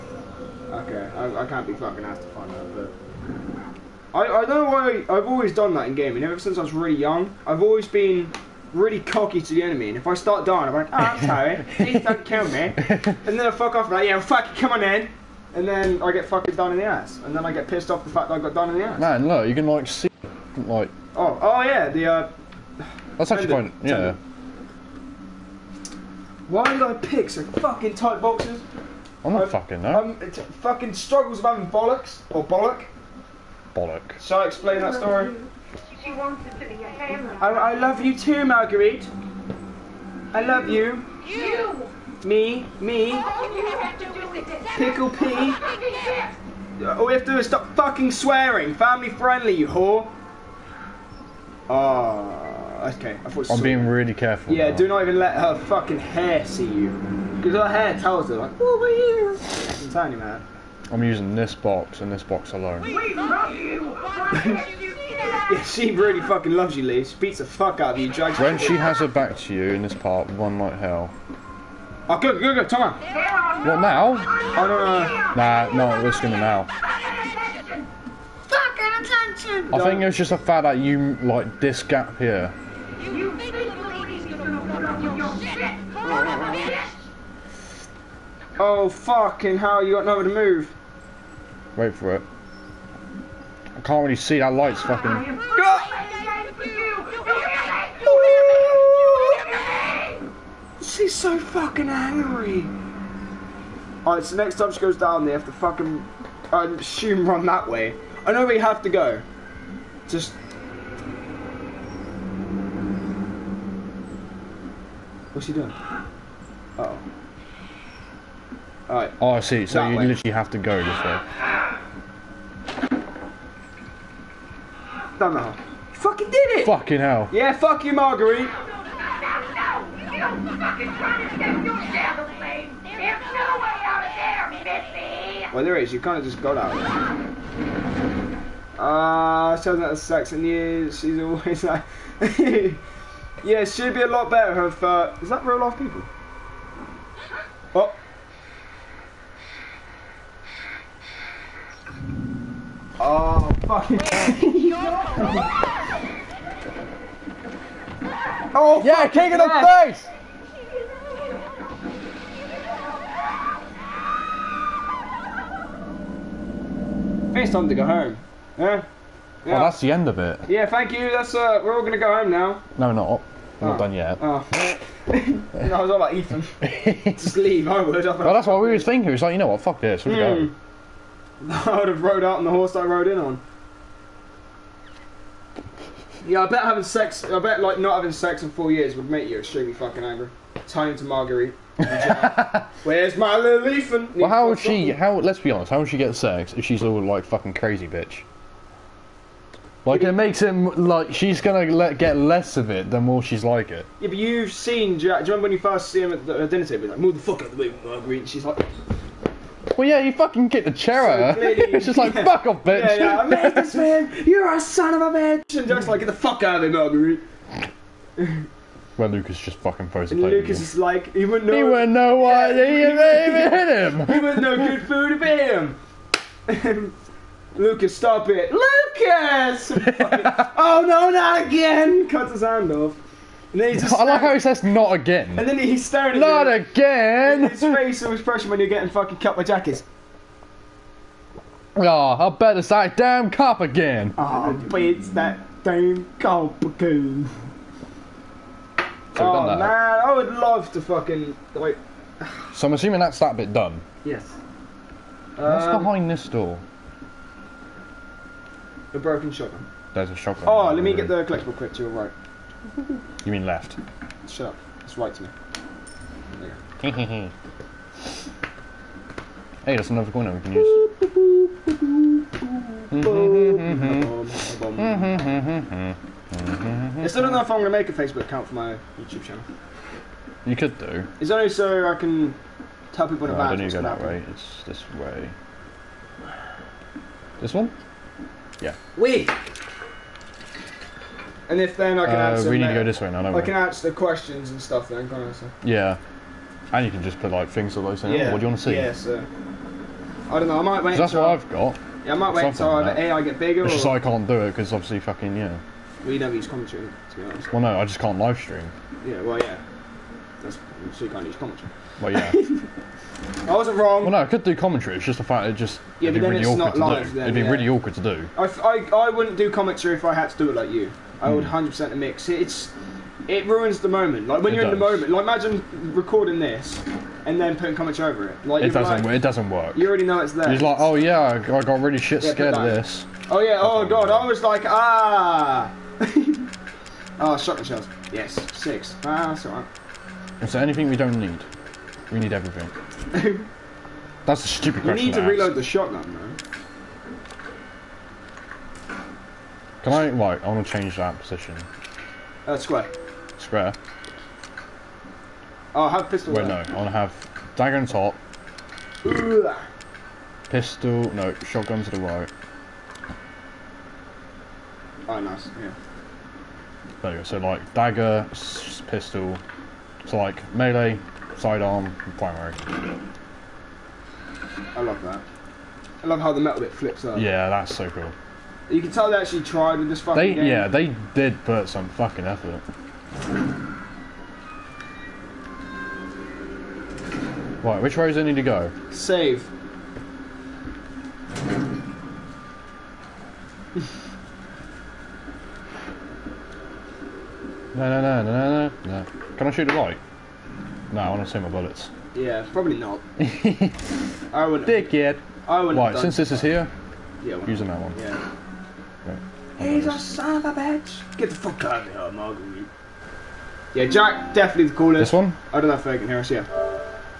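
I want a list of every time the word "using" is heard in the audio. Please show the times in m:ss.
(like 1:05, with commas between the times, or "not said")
1:01, 6:47.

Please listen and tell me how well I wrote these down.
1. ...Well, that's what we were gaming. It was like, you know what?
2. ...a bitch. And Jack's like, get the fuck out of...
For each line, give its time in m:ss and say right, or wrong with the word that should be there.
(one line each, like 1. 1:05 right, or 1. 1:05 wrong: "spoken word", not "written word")
1. 2:58 wrong: "thinking", not "gaming"
2. 3:35 right.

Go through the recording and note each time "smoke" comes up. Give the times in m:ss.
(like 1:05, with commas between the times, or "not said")
not said.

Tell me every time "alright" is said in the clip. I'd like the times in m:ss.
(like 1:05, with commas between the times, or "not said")
1:44, 1:58, 5:39.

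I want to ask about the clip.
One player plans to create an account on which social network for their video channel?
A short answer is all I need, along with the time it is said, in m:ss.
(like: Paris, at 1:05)
Facebook, at 4:37.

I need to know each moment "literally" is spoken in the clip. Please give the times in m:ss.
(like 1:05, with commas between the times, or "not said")
2:00.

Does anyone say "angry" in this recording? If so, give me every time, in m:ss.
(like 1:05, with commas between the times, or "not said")
1:41, 3:10.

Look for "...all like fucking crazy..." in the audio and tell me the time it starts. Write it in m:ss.
3:16.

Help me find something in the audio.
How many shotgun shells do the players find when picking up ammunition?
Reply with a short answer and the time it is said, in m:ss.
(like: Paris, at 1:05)
6, at 5:38.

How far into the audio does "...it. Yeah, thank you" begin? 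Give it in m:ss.
2:50.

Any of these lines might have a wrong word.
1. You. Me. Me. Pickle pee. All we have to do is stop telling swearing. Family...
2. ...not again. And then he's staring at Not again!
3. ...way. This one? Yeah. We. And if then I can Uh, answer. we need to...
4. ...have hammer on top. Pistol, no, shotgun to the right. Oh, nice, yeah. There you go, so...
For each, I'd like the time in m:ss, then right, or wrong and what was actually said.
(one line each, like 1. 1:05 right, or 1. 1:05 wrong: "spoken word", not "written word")
1. 0:41 wrong: "fucking", not "telling"
2. 3:54 right
3. 4:44 right
4. 5:56 wrong: "dagger", not "hammer".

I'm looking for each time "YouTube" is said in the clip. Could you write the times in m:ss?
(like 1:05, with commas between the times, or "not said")
4:38.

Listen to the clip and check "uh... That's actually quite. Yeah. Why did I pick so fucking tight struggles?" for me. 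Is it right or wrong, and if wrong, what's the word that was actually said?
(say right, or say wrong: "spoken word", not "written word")
wrong: "boxes", not "struggles".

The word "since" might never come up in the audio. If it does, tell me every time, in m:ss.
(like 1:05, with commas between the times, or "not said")
0:06, 6:45.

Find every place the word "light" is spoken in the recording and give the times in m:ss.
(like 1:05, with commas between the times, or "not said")
1:34, 6:39.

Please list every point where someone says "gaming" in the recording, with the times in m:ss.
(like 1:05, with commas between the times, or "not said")
0:05.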